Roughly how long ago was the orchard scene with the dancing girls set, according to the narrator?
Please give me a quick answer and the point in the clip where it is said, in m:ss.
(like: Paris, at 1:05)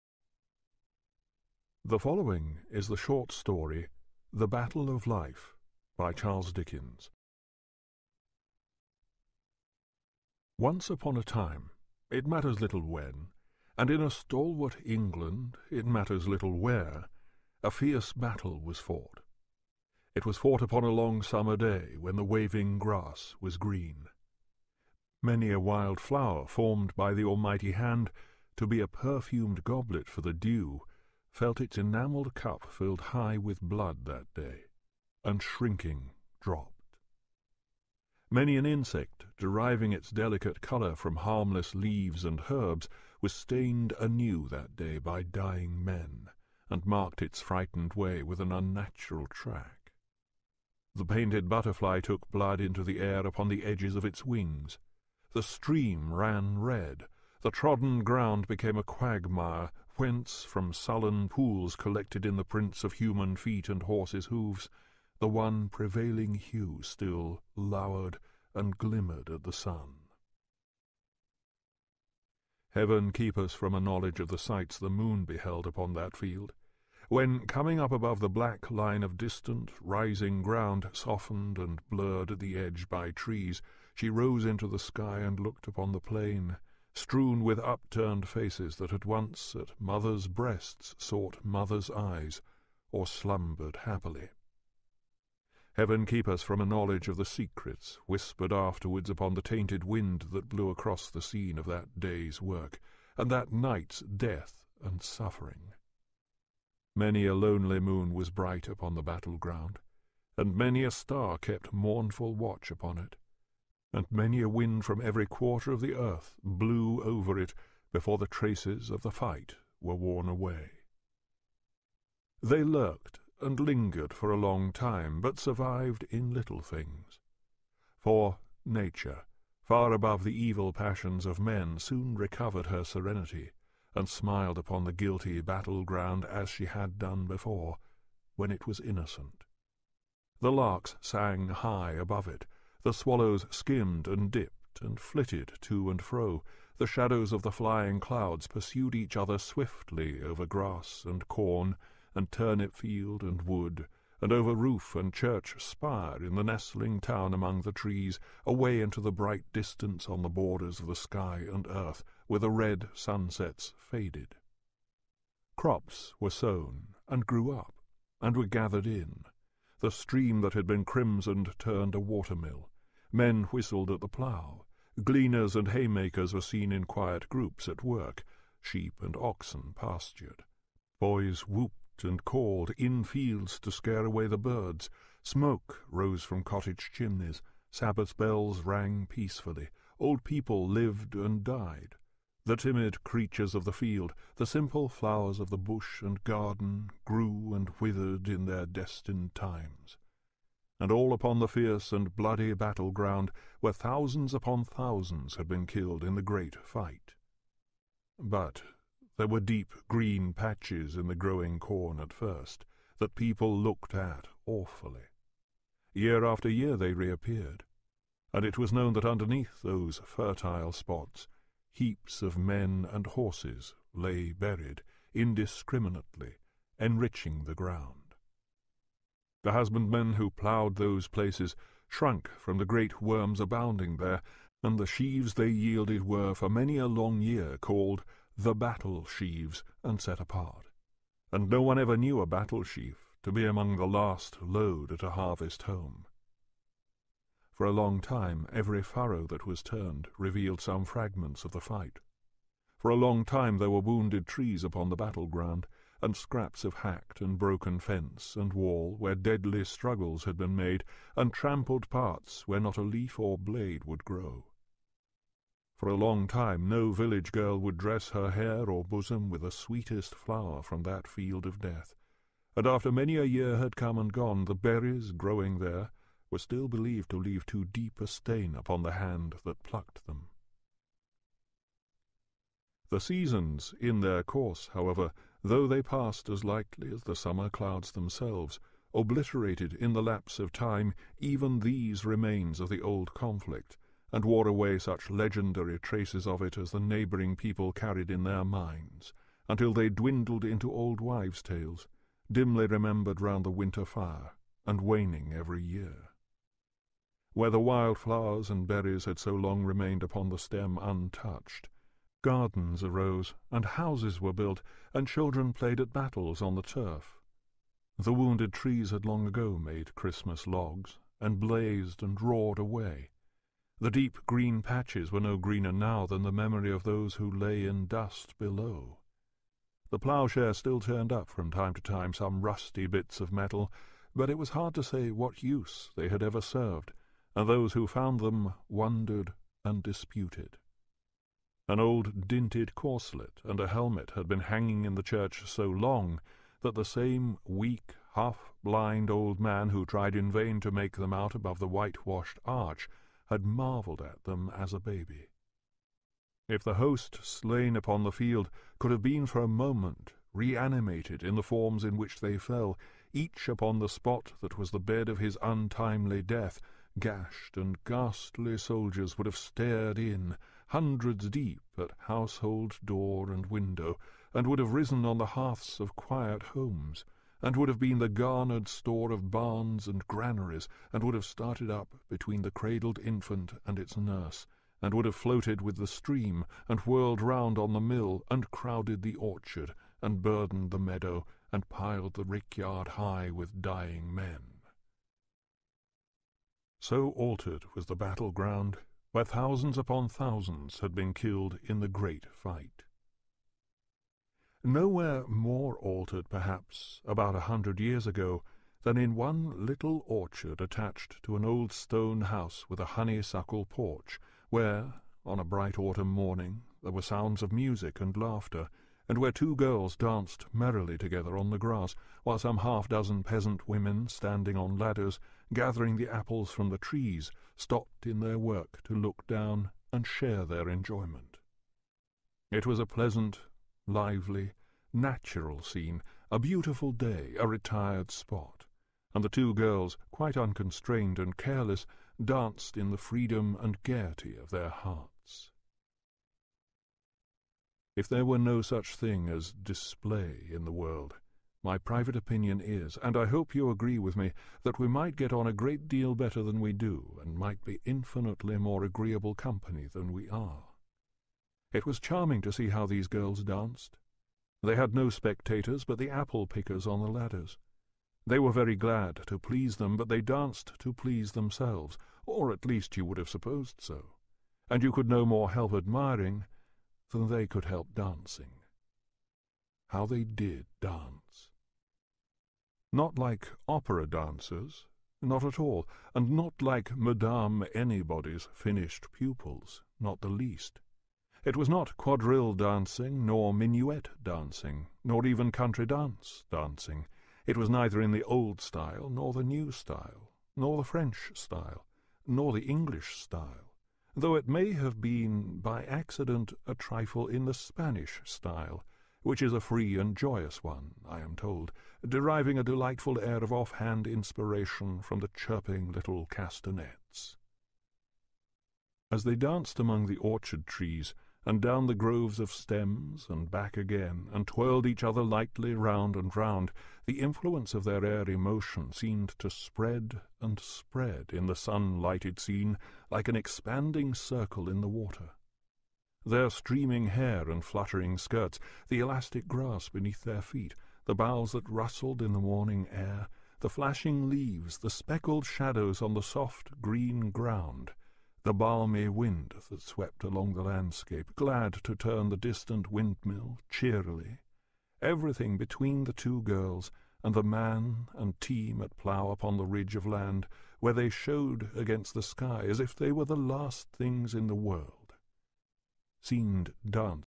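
about 100 years ago, at 6:47.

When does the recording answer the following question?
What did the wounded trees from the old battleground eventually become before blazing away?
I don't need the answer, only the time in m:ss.
5:19.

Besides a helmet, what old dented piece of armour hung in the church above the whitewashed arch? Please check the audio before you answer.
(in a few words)
corselet.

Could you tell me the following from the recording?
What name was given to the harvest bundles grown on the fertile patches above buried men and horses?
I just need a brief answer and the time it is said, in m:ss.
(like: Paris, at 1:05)
battle sheaves, at 3:58.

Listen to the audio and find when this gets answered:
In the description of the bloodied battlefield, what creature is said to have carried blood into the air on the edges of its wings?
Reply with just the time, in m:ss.
0:51.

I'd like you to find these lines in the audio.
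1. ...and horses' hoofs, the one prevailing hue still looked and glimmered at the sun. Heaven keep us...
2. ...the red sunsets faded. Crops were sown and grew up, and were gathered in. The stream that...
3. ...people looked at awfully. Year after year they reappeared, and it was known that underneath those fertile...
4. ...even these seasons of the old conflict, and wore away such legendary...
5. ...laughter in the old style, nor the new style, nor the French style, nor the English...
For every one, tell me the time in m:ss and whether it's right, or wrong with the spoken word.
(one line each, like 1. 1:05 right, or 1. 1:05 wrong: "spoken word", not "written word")
1. 1:03 wrong: "lowered", not "looked"
2. 2:42 right
3. 3:33 right
4. 4:51 wrong: "remains", not "seasons"
5. 8:17 wrong: "neither", not "laughter".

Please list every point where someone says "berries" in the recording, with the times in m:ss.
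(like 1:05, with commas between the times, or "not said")
4:34, 5:08.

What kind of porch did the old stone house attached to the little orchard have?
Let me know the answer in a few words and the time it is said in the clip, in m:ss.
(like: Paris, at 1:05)
honeysuckle porch, at 6:52.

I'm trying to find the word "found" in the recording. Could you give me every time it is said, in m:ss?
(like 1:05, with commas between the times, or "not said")
5:37.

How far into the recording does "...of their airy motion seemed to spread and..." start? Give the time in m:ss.
8:47.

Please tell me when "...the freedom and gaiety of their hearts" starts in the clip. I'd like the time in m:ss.
7:22.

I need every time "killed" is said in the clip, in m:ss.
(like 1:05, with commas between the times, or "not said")
3:25, 6:41.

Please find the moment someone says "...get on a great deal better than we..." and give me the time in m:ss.
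7:35.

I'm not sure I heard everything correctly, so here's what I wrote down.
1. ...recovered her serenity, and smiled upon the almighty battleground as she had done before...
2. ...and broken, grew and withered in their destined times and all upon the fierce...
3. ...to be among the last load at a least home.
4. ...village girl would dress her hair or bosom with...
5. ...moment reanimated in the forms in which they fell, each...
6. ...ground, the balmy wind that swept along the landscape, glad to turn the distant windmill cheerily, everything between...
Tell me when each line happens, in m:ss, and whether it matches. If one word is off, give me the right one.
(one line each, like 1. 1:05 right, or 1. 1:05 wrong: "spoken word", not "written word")
1. 2:12 wrong: "guilty", not "almighty"
2. 3:16 wrong: "garden", not "broken"
3. 4:03 wrong: "harvest", not "least"
4. 4:26 right
5. 5:59 right
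6. 9:07 right.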